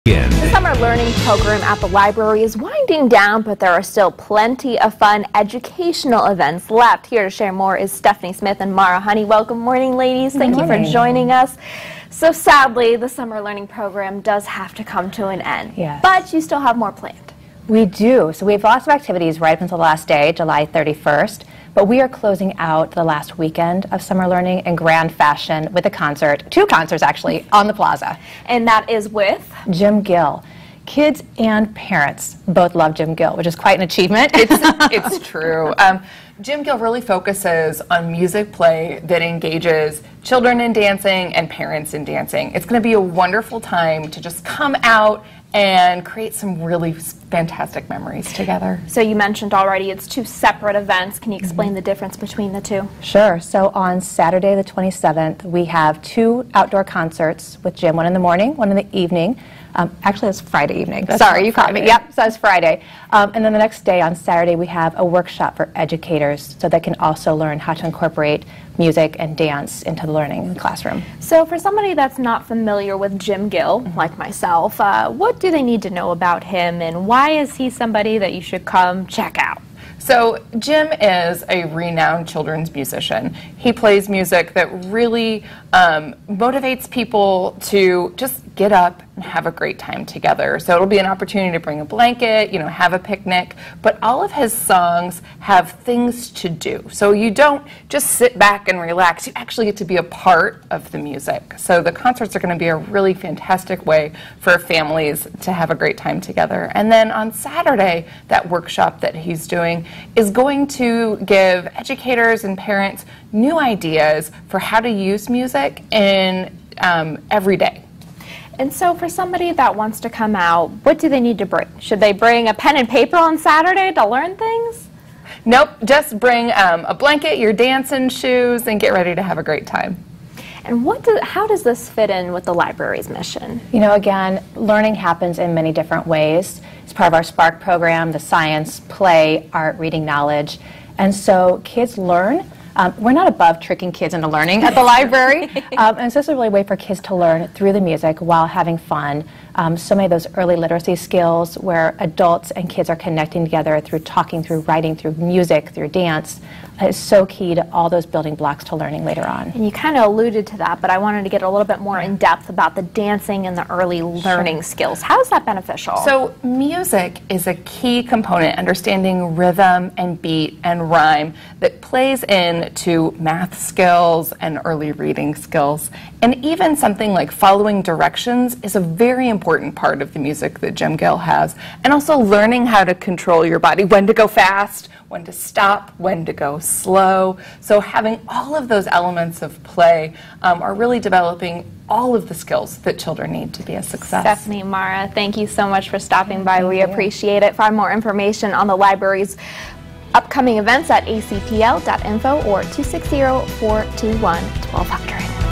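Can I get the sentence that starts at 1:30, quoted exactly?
So it'll be an opportunity to bring a blanket, you know, have a picnic.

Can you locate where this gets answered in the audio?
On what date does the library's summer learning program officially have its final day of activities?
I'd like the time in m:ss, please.
0:20.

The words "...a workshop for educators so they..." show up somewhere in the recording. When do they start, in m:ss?
1:04.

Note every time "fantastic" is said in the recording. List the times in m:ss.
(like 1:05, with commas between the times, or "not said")
0:46, 1:43.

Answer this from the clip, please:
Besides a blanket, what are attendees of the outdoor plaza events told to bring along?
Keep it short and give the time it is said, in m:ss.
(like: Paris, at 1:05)
dancing shoes, at 2:07.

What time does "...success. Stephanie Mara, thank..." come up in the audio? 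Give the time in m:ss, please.
3:13.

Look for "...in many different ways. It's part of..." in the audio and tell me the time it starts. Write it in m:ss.
2:15.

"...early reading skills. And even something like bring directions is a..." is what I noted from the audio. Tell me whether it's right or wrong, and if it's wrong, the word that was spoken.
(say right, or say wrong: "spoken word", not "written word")
wrong: "following", not "bring".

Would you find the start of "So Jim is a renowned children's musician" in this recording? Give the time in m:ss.
1:20.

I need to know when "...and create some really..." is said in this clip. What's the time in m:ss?
0:45.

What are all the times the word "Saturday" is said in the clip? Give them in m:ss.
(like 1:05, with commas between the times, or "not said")
0:54, 1:04, 1:47, 2:03.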